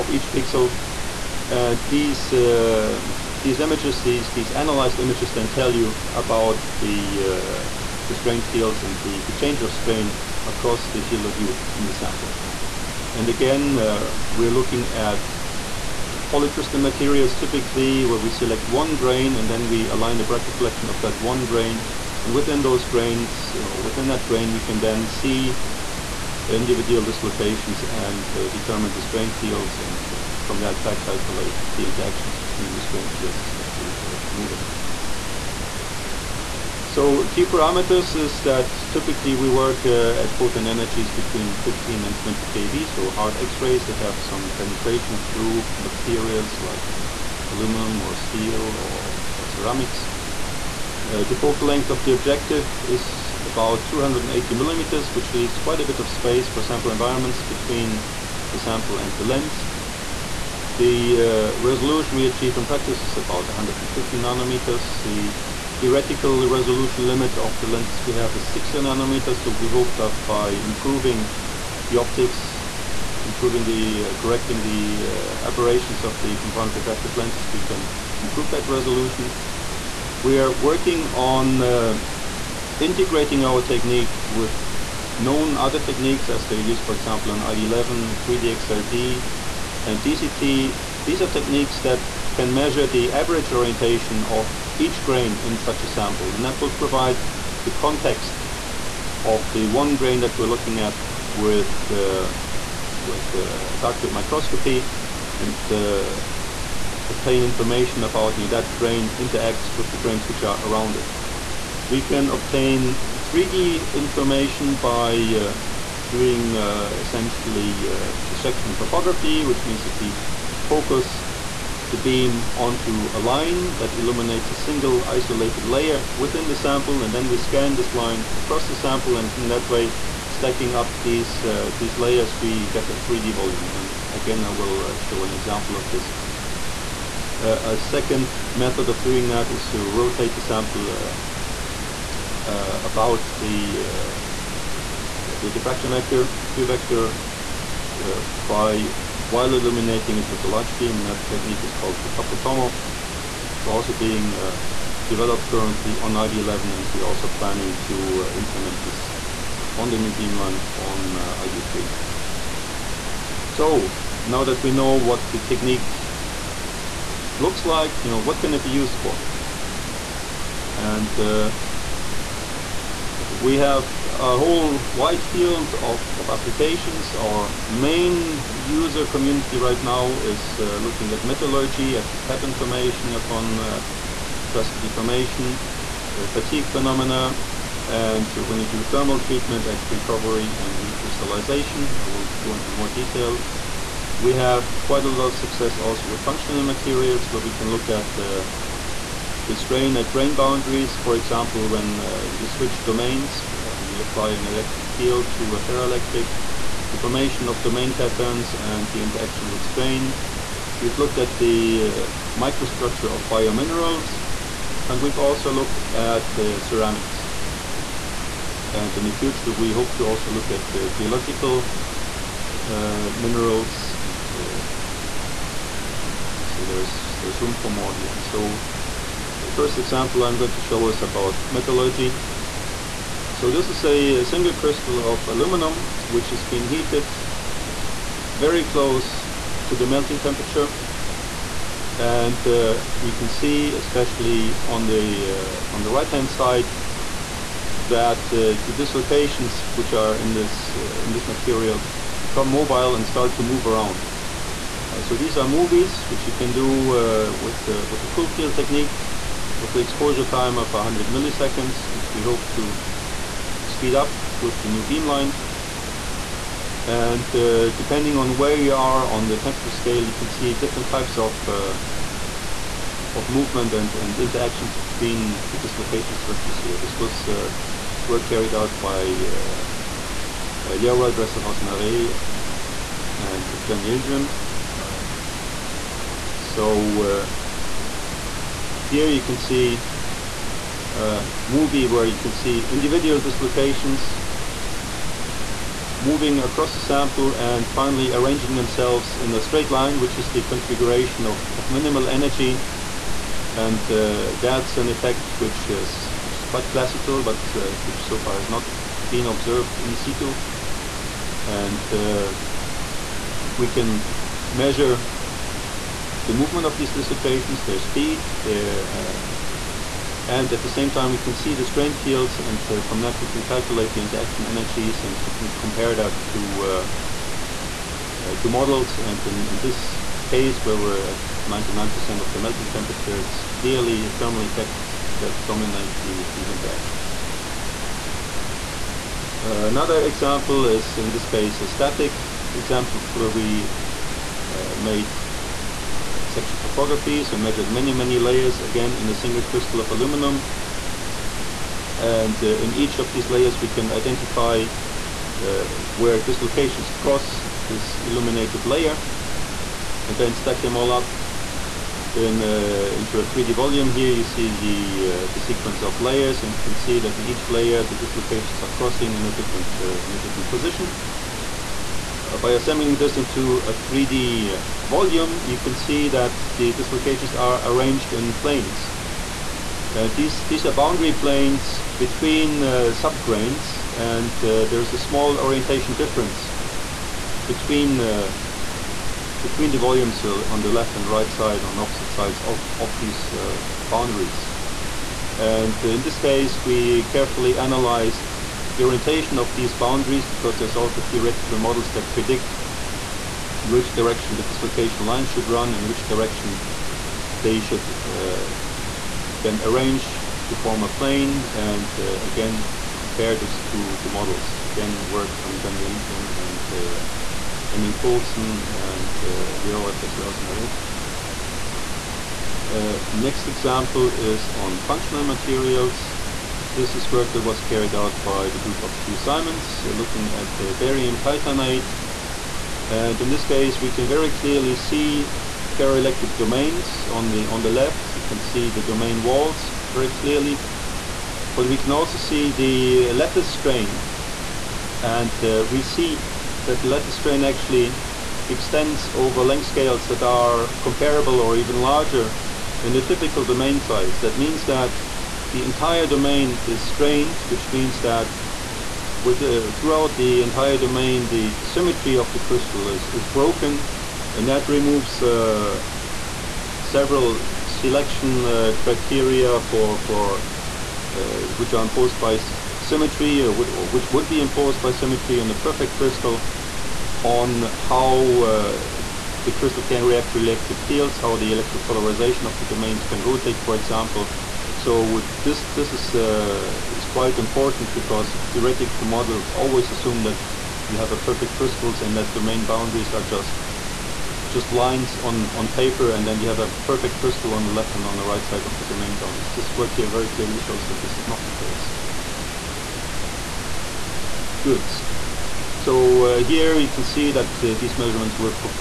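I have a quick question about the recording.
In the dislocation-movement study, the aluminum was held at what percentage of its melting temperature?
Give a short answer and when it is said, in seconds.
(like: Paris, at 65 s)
99%, at 331 s.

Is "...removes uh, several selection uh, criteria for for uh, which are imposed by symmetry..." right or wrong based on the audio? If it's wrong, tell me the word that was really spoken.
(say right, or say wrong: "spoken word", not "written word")
right.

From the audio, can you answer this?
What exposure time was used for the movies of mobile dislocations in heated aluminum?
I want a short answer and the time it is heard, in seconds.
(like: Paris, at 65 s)
100 milliseconds, at 260 s.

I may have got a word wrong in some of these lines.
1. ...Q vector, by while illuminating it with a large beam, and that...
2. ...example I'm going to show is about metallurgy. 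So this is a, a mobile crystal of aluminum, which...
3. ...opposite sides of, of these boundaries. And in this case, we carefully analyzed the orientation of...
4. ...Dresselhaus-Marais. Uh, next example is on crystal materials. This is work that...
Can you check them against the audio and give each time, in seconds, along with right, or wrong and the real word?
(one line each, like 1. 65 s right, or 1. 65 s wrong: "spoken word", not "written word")
1. 146 s right
2. 229 s wrong: "single", not "mobile"
3. 391 s right
4. 419 s wrong: "functional", not "crystal".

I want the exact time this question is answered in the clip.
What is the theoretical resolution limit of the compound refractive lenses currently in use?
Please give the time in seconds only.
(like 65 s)
68 s.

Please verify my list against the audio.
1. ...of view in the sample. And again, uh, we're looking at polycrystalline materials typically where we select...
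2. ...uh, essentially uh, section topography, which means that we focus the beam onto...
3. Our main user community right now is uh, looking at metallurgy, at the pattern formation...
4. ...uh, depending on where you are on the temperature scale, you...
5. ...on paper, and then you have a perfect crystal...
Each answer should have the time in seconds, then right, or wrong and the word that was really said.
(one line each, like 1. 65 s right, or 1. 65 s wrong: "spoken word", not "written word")
1. 11 s right
2. 116 s right
3. 177 s right
4. 267 s right
5. 495 s right.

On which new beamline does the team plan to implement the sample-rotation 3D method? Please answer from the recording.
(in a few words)
ID3.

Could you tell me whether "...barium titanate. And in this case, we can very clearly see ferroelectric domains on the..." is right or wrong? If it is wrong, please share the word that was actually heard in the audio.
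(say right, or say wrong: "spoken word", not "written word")
right.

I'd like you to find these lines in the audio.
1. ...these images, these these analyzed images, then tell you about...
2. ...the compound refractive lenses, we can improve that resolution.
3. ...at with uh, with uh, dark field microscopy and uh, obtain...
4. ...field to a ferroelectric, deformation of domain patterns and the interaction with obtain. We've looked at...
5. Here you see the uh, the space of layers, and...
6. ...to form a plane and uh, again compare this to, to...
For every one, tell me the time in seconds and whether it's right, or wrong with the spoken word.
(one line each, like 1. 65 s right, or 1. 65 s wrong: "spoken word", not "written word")
1. 3 s right
2. 76 s right
3. 100 s right
4. 204 s wrong: "strain", not "obtain"
5. 363 s wrong: "sequence", not "space"
6. 410 s right.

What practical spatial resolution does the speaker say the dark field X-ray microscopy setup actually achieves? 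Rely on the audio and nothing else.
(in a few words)
150 nanometers.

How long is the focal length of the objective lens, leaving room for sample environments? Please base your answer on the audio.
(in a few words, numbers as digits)
280 millimeters.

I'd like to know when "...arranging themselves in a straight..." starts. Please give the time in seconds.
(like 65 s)
298 s.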